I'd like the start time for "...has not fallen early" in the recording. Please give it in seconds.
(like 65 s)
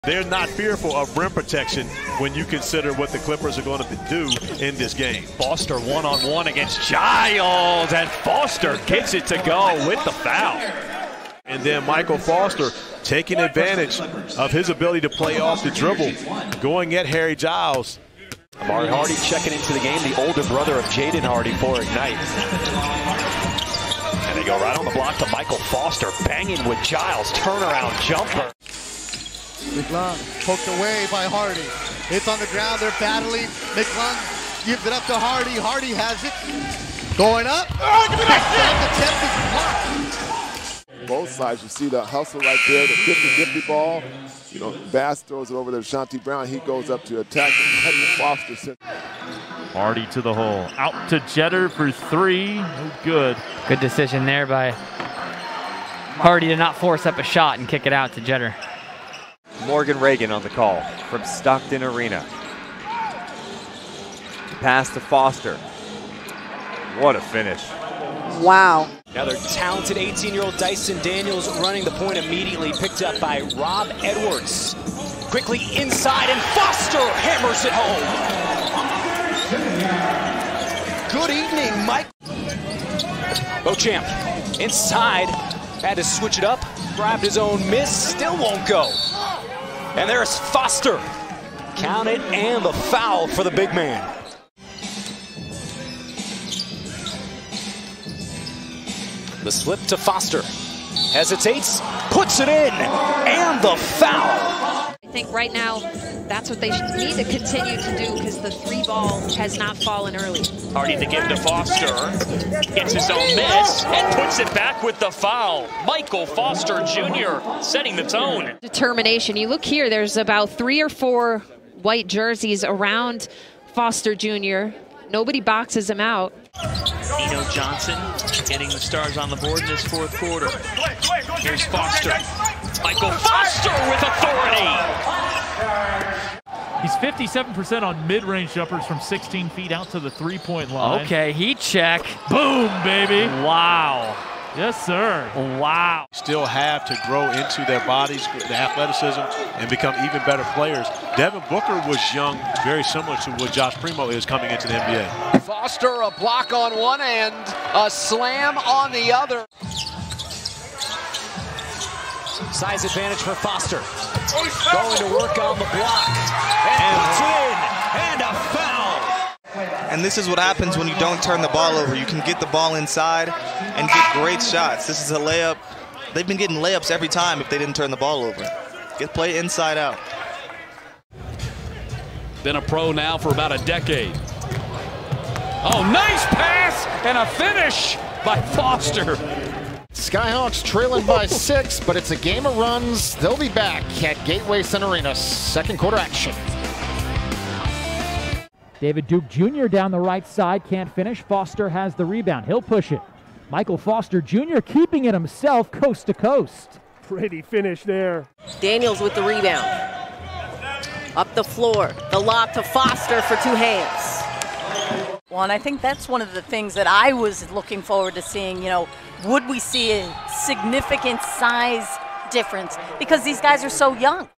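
109 s.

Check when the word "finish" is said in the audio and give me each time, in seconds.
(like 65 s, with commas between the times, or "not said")
67 s, 187 s, 200 s, 207 s.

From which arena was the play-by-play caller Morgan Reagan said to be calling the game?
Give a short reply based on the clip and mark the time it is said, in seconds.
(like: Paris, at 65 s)
Stockton Arena, at 61 s.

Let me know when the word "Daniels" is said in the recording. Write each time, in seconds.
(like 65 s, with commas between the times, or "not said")
71 s, 208 s.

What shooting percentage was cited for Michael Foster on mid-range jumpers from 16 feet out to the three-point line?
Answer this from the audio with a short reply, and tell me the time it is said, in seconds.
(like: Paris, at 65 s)
57%, at 136 s.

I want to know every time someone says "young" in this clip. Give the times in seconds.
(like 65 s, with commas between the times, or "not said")
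152 s, 223 s.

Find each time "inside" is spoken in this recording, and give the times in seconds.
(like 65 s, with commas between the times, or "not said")
75 s, 84 s, 172 s, 179 s.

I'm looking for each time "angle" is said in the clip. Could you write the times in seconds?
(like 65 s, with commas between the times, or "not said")
not said.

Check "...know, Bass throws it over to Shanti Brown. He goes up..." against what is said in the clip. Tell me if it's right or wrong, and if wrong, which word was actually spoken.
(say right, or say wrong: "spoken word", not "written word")
right.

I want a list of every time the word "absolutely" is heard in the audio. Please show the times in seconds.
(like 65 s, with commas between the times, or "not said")
not said.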